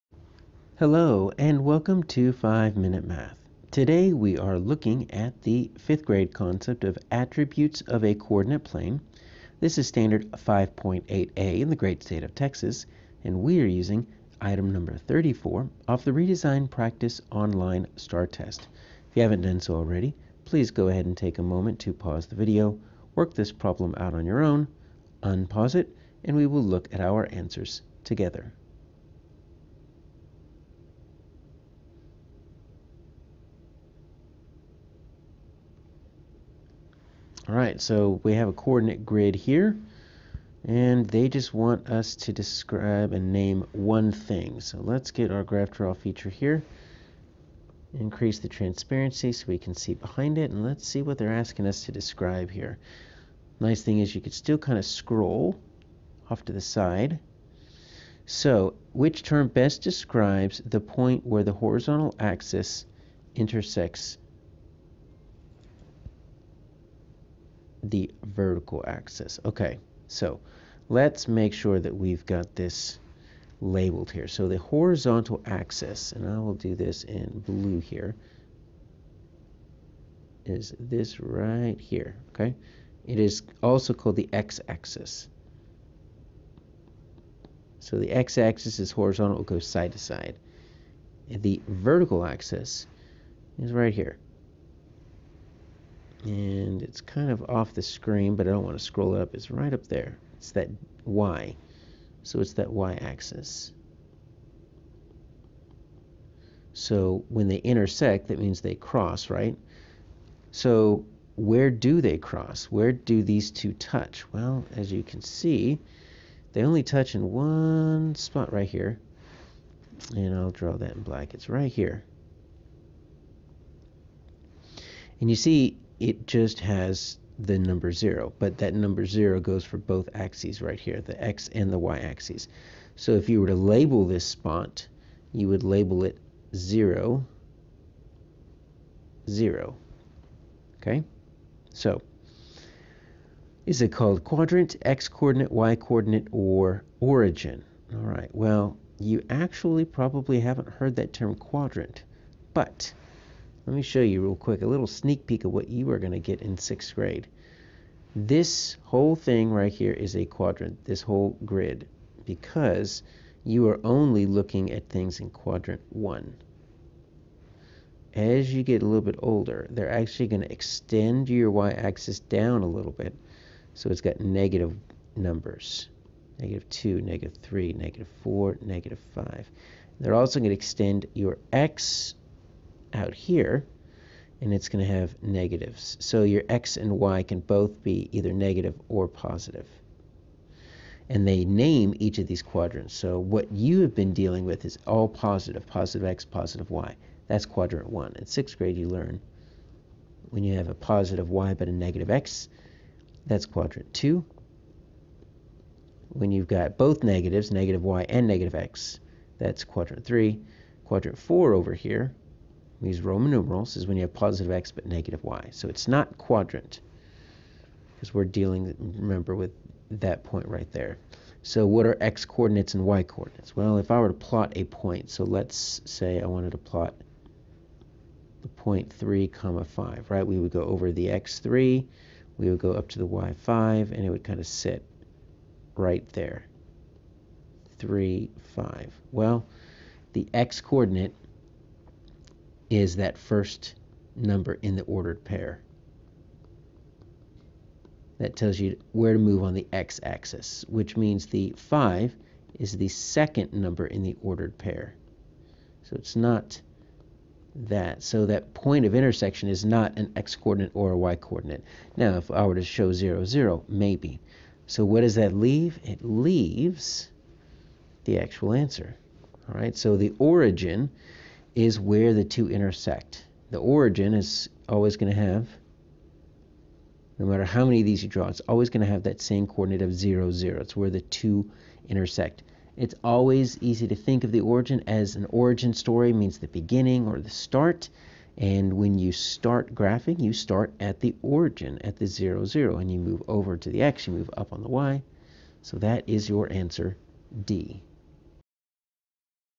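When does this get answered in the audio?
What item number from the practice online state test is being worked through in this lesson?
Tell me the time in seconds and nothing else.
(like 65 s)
14 s.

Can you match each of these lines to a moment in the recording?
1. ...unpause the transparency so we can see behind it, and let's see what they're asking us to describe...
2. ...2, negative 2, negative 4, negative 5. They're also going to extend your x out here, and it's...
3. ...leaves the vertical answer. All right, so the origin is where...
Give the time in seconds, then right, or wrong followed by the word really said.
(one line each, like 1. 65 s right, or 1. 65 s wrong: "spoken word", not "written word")
1. 47 s wrong: "increase", not "unpause"
2. 176 s wrong: "3", not "2"
3. 266 s wrong: "actual", not "vertical".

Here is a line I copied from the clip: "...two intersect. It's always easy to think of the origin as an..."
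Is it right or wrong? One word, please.
right.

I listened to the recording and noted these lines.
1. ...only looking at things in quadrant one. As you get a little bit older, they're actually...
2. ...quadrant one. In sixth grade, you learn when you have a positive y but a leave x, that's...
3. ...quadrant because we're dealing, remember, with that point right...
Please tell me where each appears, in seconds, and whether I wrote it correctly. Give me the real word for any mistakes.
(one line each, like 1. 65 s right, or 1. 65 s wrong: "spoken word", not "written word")
1. 163 s right
2. 197 s wrong: "negative", not "leave"
3. 216 s right.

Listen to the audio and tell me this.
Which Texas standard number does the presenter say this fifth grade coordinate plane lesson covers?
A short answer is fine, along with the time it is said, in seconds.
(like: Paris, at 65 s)
5.8a, at 10 s.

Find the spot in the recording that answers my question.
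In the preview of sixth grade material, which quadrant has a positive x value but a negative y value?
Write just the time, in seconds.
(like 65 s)
210 s.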